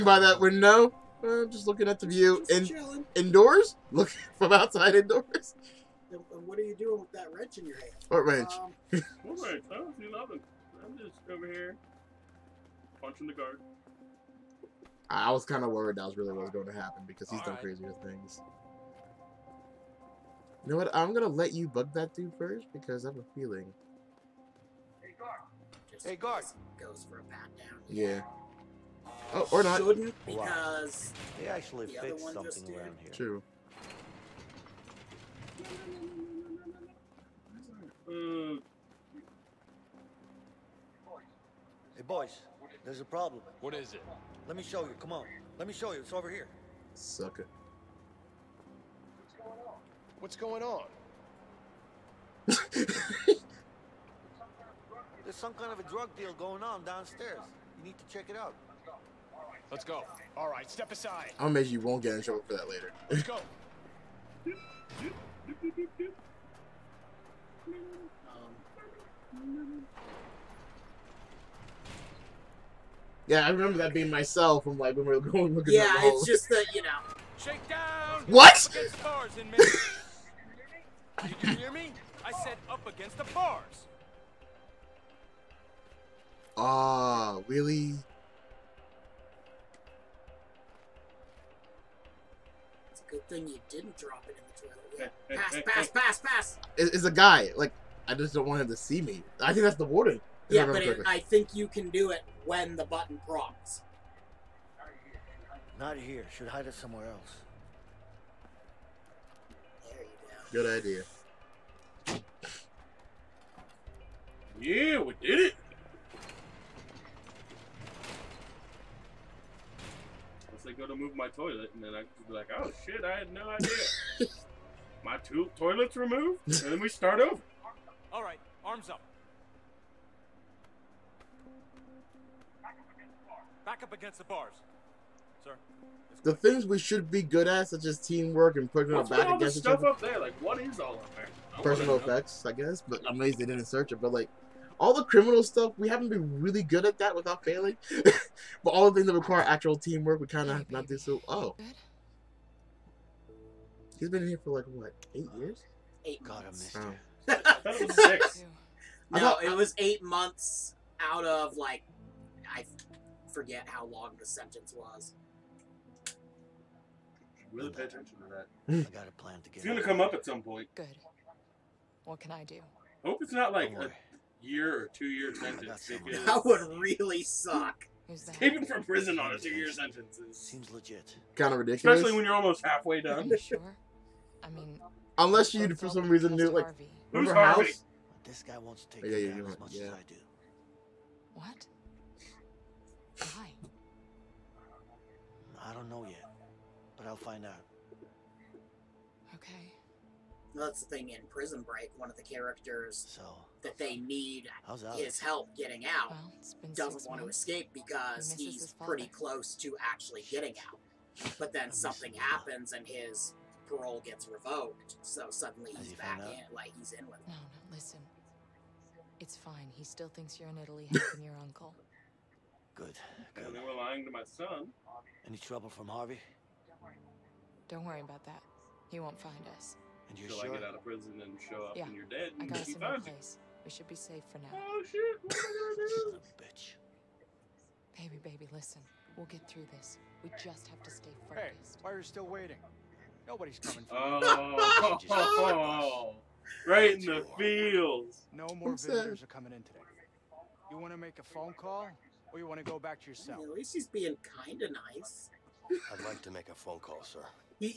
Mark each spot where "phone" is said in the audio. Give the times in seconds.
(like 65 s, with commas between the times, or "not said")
251 s, 256 s.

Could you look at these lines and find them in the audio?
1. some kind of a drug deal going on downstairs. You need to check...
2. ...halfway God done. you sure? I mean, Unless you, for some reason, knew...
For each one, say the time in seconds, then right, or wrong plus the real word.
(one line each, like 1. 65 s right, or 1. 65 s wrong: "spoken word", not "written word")
1. 55 s right
2. 182 s wrong: "Are", not "God".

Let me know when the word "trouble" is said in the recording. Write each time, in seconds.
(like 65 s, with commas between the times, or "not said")
62 s, 225 s.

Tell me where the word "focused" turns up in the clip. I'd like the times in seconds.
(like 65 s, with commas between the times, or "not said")
241 s.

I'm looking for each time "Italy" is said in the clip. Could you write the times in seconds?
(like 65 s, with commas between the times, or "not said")
220 s.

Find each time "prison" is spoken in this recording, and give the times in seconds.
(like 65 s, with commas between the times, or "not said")
178 s, 201 s, 230 s.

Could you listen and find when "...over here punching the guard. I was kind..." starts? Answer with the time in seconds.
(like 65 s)
11 s.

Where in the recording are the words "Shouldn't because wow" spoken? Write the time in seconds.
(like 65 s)
29 s.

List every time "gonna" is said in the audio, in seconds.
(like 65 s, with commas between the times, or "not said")
169 s, 235 s.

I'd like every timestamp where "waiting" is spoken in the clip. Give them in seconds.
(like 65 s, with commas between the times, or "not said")
242 s.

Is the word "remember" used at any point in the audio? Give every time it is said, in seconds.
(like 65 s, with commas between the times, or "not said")
73 s, 187 s.